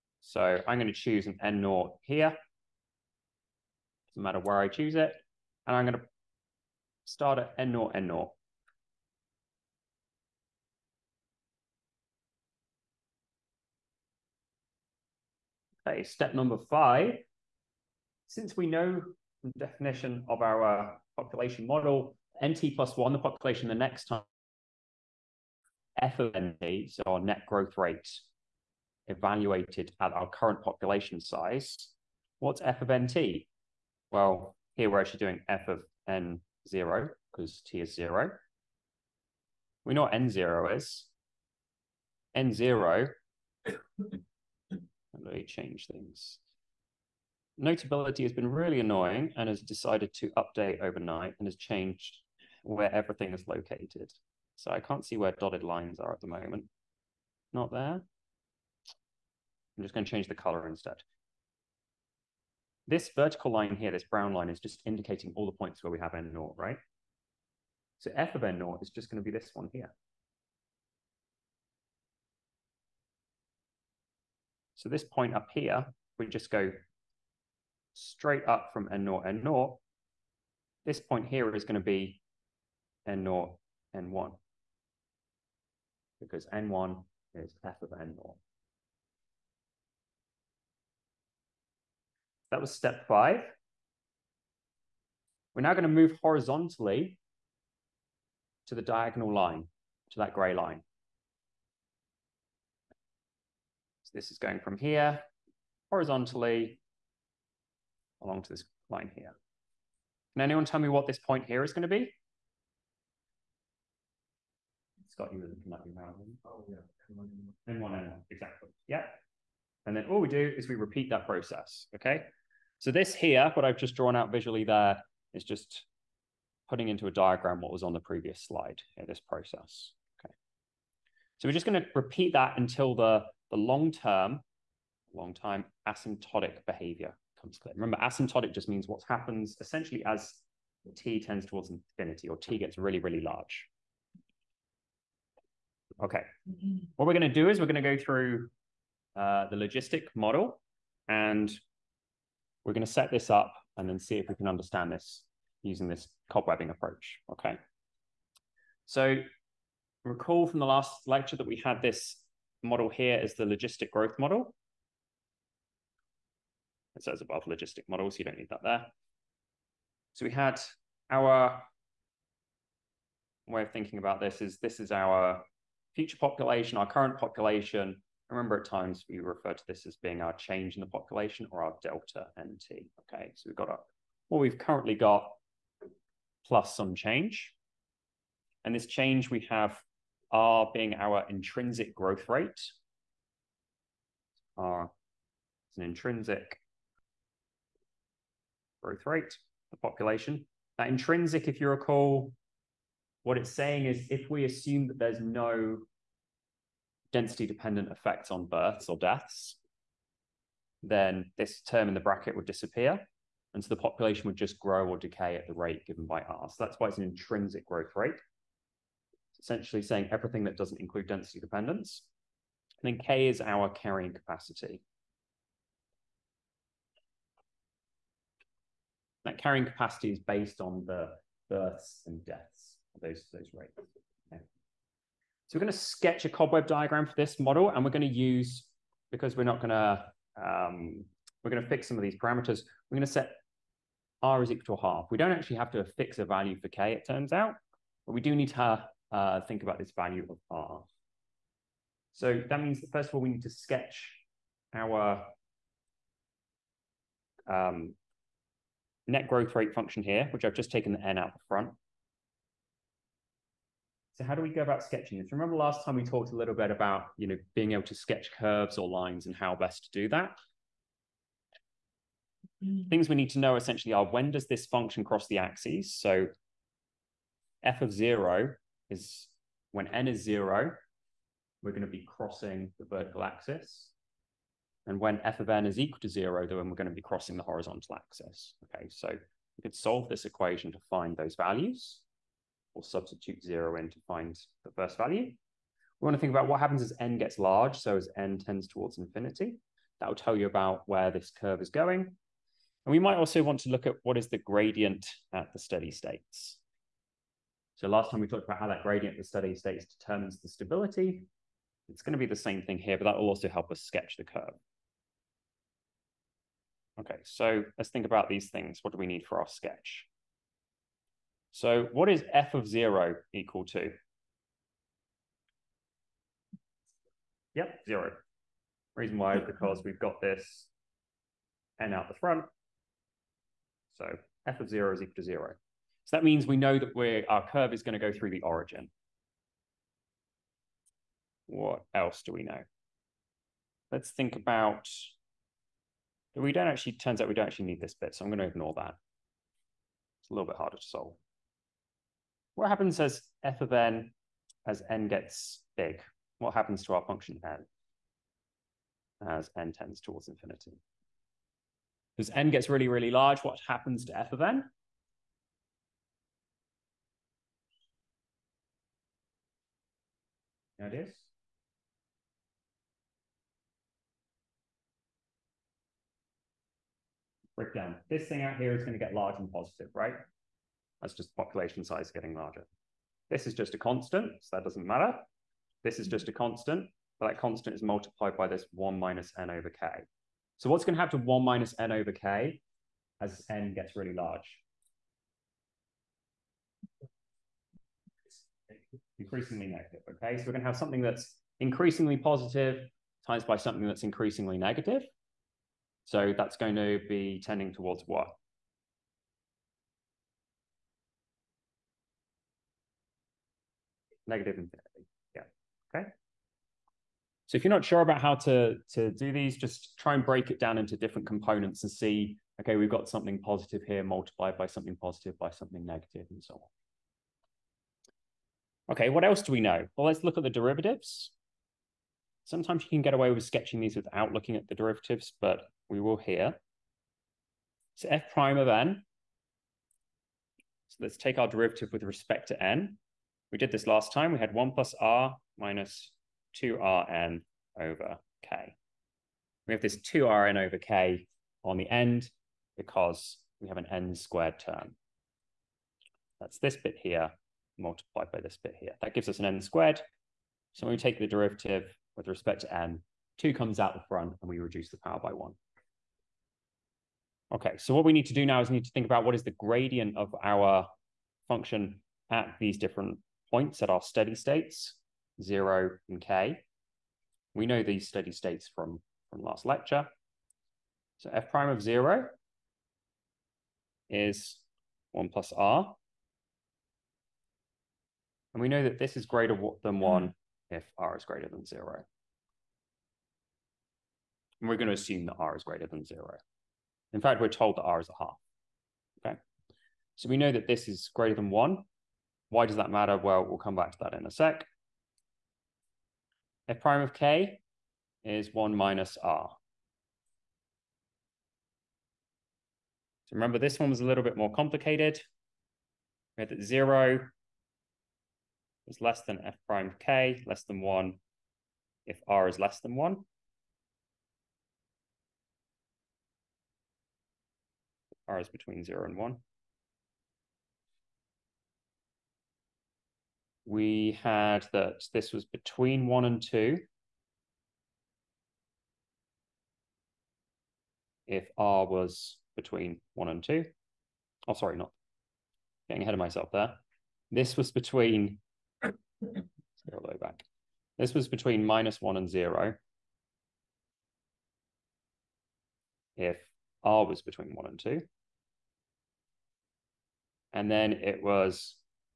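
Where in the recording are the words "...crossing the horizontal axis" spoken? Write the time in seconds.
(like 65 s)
287 s.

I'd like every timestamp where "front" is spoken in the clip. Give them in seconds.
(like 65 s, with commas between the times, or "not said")
261 s, 332 s, 464 s.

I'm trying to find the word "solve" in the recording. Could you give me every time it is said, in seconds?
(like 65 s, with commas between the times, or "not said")
289 s, 350 s.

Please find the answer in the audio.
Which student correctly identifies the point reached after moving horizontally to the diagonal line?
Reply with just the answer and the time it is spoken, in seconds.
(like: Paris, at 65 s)
Scott, at 115 s.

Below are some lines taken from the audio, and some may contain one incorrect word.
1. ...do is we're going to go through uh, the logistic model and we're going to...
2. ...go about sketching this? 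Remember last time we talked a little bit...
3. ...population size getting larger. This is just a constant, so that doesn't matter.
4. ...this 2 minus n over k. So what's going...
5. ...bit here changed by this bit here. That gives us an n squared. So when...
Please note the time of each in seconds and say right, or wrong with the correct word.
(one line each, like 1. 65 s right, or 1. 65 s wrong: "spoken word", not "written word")
1. 147 s right
2. 264 s right
3. 381 s right
4. 388 s wrong: "1", not "2"
5. 456 s wrong: "multiplied", not "changed".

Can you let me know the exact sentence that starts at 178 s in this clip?
Remember, at times we refer to this as being our change in the population or our delta NT.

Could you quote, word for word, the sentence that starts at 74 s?
So this point up here, we just go straight up from n naught, n naught.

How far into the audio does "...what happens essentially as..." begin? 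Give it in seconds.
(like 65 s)
138 s.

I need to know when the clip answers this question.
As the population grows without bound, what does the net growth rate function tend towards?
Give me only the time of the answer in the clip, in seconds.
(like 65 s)
414 s.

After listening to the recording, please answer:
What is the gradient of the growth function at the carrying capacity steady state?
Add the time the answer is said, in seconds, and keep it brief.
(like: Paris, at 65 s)
1 minus r, at 508 s.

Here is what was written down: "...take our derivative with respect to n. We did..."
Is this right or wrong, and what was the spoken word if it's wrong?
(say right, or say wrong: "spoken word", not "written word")
right.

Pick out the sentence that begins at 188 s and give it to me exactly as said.
And this change we have R being our intrinsic growth rate.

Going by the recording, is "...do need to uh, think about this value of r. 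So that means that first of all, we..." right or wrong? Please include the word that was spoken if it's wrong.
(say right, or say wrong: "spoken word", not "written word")
right.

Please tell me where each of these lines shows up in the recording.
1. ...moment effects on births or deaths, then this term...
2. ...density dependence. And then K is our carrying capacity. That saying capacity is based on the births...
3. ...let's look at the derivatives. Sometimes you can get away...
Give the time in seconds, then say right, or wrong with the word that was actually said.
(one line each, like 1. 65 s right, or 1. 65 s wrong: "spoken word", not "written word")
1. 207 s wrong: "dependent", not "moment"
2. 221 s wrong: "carrying", not "saying"
3. 430 s right.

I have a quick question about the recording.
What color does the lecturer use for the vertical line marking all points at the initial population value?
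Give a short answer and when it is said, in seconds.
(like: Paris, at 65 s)
Brown, at 64 s.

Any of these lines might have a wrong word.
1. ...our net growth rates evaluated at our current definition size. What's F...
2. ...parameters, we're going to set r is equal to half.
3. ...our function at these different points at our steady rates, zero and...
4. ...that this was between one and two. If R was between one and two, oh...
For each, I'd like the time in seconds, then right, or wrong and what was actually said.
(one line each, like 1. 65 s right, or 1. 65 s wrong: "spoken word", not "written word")
1. 27 s wrong: "population", not "definition"
2. 242 s right
3. 470 s wrong: "states", not "rates"
4. 534 s right.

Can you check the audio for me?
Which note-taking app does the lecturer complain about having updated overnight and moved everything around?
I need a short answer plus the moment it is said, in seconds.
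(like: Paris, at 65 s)
Notability, at 47 s.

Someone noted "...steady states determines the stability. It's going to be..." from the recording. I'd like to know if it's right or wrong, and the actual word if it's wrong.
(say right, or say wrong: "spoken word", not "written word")
right.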